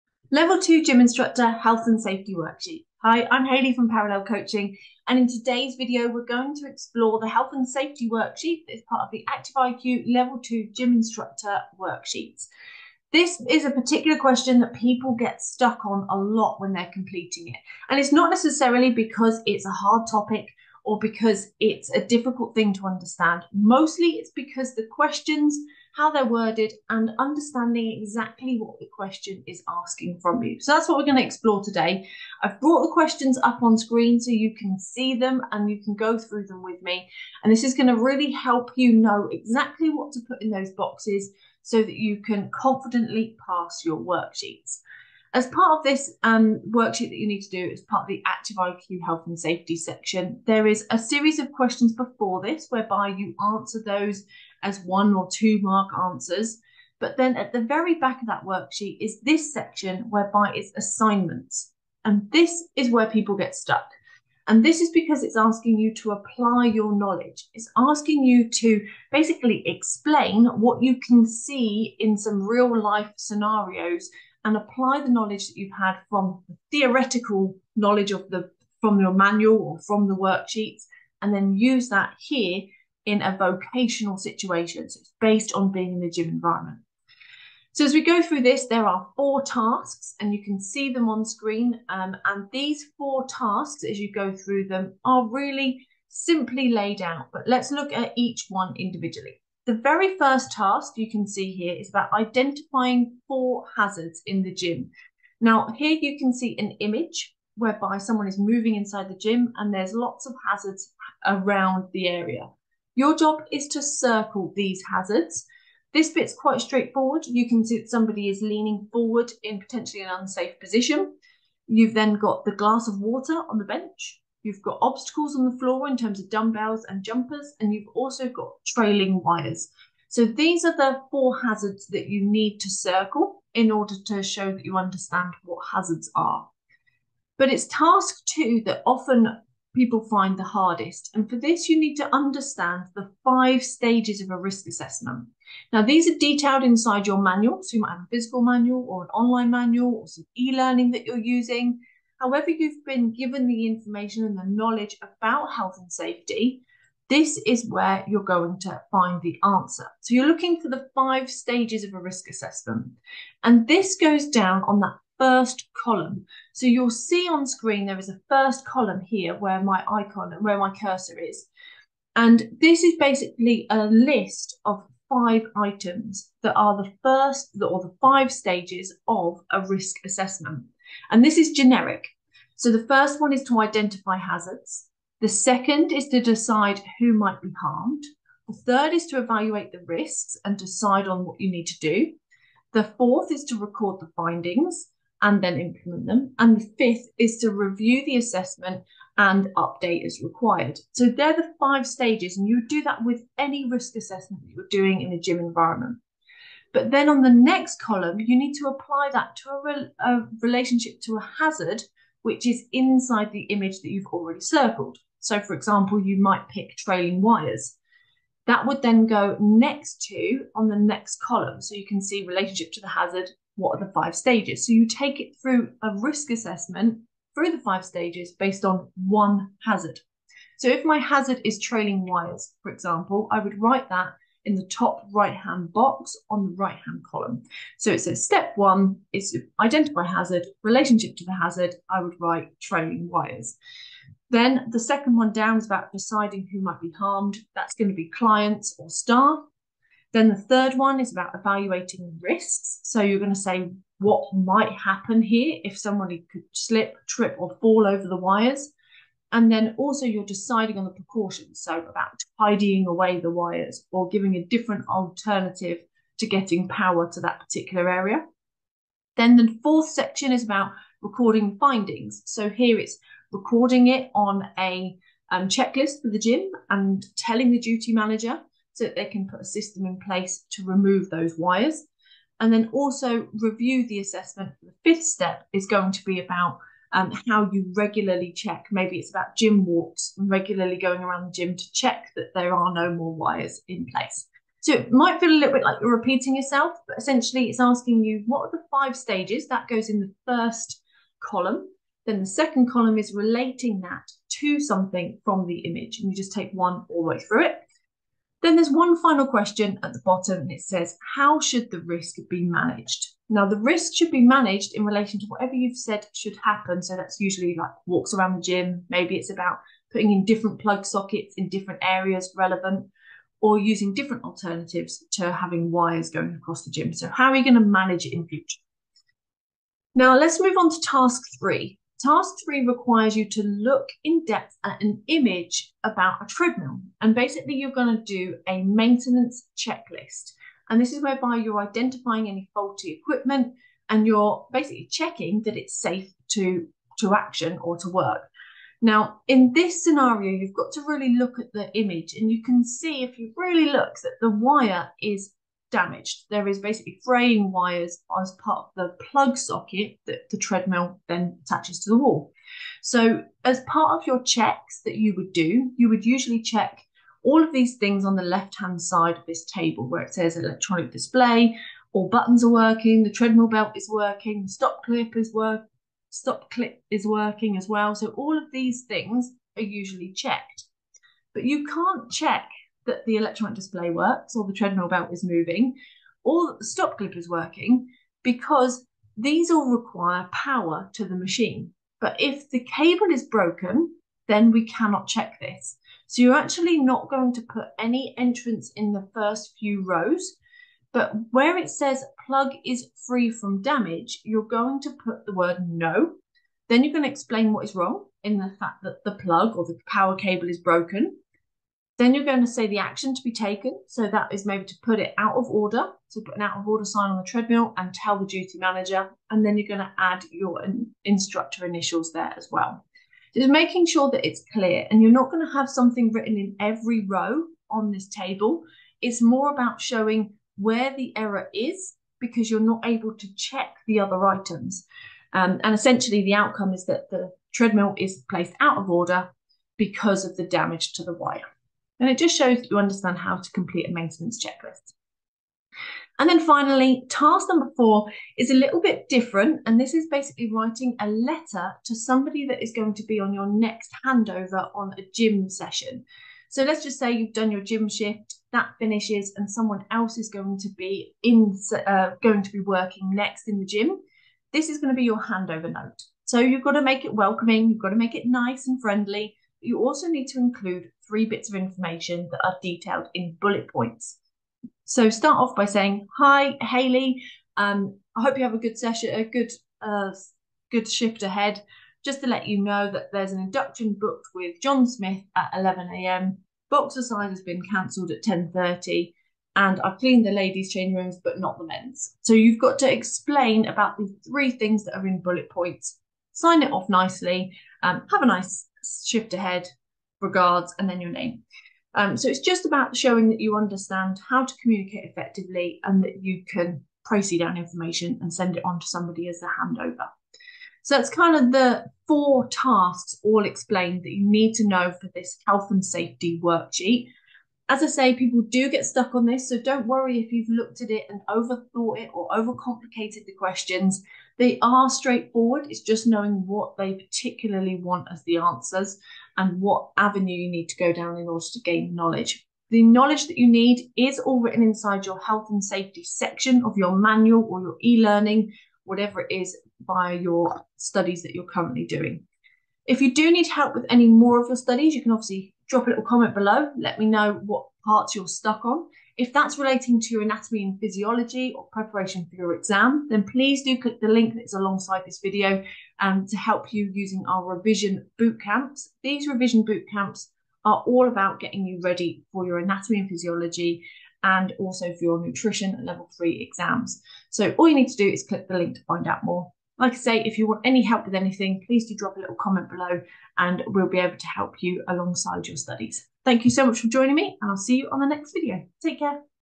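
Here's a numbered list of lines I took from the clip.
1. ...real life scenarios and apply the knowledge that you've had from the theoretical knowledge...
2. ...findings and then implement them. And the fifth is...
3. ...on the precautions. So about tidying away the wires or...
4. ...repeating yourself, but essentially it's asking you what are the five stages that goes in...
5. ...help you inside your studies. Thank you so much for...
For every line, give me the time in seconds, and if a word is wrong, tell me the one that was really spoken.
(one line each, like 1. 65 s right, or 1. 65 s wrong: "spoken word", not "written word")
1. 72 s right
2. 194 s right
3. 260 s right
4. 295 s right
5. 574 s wrong: "alongside", not "inside".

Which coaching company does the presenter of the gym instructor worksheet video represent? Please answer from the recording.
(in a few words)
Parallel Coaching.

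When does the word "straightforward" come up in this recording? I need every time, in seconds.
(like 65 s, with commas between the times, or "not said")
116 s, 524 s.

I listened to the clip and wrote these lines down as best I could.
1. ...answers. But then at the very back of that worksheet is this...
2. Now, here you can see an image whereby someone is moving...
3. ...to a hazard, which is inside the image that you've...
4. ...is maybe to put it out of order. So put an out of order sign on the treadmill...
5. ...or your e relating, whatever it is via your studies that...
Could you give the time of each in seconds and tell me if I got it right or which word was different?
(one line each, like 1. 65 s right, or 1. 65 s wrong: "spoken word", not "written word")
1. 55 s right
2. 105 s right
3. 211 s right
4. 414 s right
5. 537 s wrong: "learning", not "relating".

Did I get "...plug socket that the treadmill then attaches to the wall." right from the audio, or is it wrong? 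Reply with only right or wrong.
right.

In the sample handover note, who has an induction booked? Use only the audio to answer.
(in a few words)
John Smith.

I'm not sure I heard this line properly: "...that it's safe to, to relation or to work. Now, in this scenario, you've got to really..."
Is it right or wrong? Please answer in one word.
wrong.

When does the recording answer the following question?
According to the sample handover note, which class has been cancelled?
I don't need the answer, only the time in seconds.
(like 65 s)
486 s.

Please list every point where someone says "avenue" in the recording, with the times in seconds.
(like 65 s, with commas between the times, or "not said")
529 s.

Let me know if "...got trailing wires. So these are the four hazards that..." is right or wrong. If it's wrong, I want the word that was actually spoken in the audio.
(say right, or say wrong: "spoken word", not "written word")
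right.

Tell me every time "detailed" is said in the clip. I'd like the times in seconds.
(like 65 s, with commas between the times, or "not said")
146 s, 472 s.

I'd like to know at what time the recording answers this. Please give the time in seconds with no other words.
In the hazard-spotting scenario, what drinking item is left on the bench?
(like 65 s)
122 s.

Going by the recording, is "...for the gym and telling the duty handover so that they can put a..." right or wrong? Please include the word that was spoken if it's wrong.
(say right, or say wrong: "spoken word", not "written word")
wrong: "manager", not "handover".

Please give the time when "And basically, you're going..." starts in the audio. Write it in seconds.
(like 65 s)
337 s.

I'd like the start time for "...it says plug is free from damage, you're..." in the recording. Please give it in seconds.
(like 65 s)
401 s.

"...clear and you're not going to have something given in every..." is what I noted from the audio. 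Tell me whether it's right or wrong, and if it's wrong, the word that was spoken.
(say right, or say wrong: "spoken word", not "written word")
wrong: "written", not "given".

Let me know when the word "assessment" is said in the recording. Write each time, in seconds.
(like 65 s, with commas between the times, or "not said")
144 s, 162 s, 180 s, 198 s, 203 s, 226 s, 283 s.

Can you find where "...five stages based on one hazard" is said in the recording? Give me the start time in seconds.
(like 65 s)
227 s.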